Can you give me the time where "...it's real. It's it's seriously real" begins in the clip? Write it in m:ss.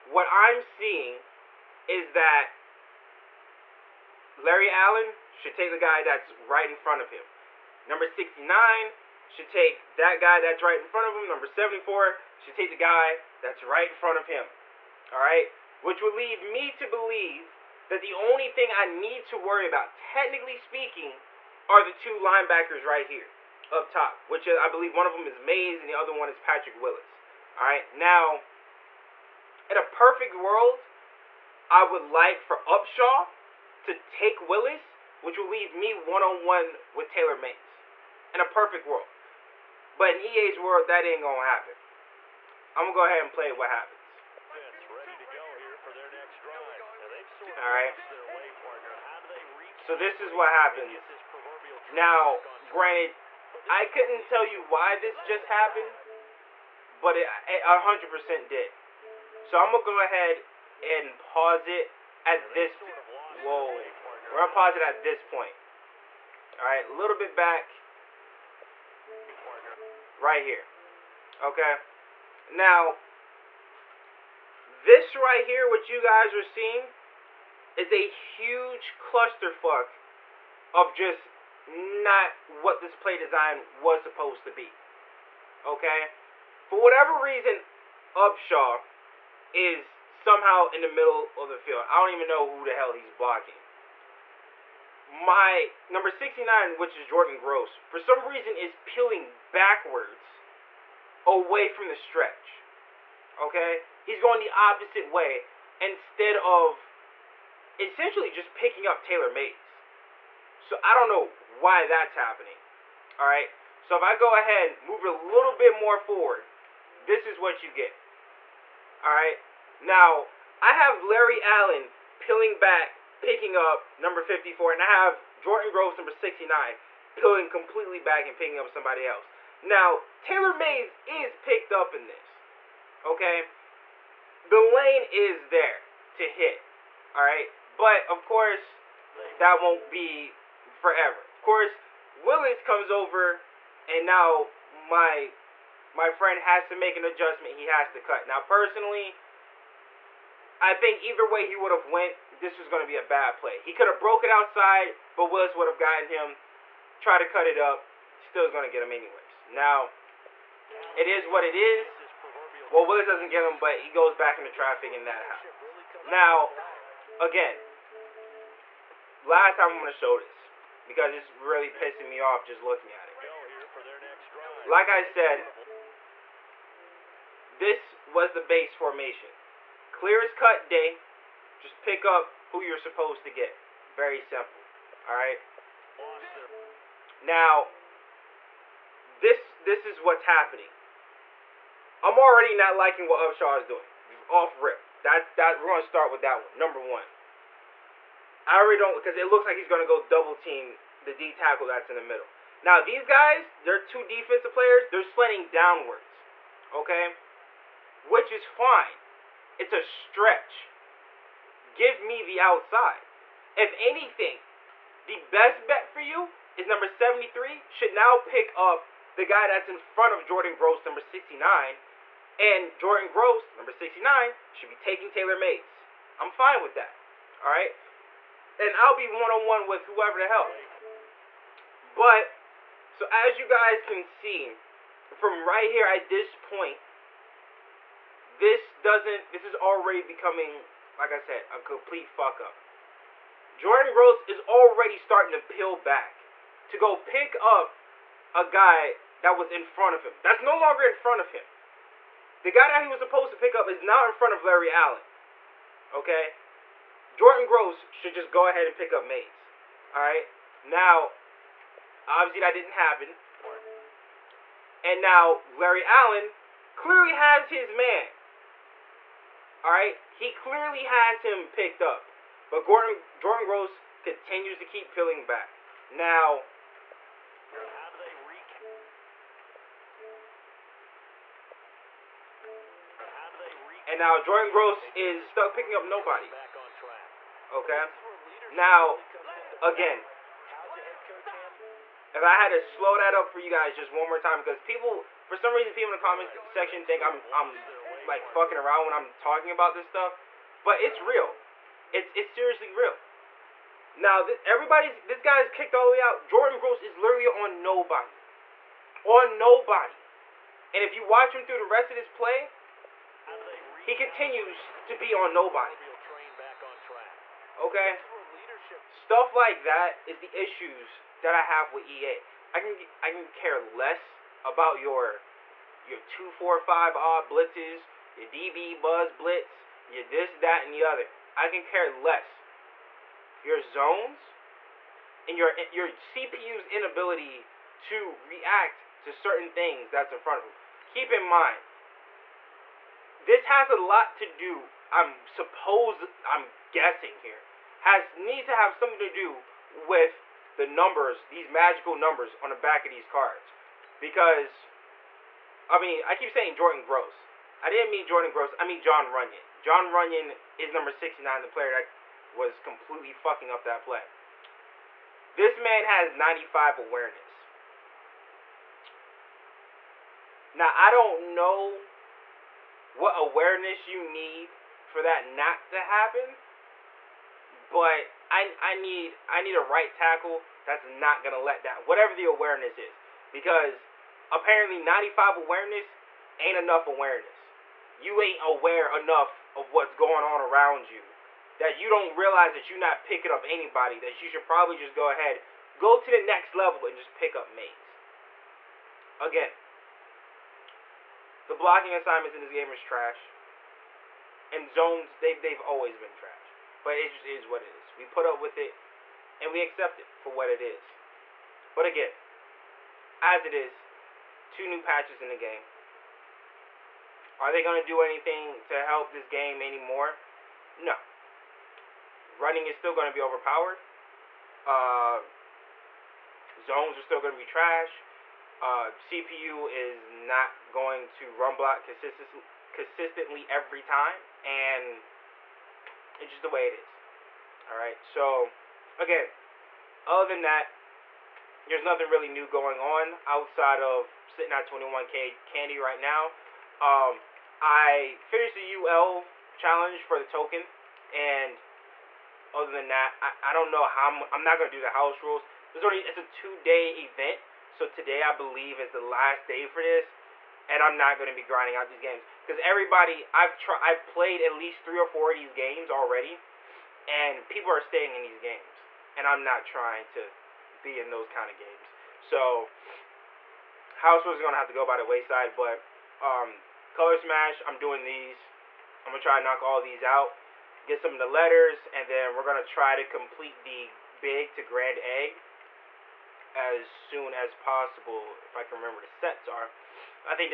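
5:00.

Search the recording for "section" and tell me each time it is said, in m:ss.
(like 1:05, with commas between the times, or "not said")
4:56.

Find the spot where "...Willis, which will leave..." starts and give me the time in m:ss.
0:34.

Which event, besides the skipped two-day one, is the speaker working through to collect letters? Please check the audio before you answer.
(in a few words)
Color Smash.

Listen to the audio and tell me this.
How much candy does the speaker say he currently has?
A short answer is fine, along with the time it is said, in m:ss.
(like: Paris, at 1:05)
21k, at 7:24.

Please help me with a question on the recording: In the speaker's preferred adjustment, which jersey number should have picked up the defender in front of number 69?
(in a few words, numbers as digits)
73.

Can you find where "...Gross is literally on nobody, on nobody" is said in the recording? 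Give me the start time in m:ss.
5:06.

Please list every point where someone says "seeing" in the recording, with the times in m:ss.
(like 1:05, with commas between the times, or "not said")
0:00, 1:16.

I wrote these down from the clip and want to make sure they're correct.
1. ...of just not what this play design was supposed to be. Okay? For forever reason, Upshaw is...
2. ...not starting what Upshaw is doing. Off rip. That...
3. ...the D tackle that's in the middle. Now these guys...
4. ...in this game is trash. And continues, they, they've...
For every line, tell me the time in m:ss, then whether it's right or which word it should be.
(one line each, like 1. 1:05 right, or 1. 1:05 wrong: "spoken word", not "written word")
1. 1:20 wrong: "whatever", not "forever"
2. 3:12 wrong: "liking", not "starting"
3. 3:21 right
4. 6:42 wrong: "zones", not "continues".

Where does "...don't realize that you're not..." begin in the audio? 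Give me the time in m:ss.
6:31.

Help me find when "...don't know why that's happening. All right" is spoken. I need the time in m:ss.
1:50.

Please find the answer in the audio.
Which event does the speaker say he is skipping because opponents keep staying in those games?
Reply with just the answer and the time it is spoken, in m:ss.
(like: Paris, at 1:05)
House Rules, at 7:34.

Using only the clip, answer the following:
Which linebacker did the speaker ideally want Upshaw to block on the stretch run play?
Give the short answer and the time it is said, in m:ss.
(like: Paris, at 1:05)
Patrick Willis, at 0:26.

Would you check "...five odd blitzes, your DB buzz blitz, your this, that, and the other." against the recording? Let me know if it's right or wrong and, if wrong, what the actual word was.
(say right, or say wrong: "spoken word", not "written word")
right.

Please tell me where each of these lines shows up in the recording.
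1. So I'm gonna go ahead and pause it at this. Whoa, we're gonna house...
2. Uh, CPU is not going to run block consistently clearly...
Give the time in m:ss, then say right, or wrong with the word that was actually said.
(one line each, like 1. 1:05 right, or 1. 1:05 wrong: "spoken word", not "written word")
1. 0:59 wrong: "pause", not "house"
2. 7:08 wrong: "consistently", not "clearly".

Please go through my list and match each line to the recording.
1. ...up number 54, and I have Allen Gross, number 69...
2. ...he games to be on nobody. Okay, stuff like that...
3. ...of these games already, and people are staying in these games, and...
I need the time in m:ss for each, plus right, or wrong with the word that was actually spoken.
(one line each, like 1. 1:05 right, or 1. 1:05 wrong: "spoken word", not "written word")
1. 2:03 wrong: "Jordan", not "Allen"
2. 5:13 wrong: "continues", not "games"
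3. 7:45 right.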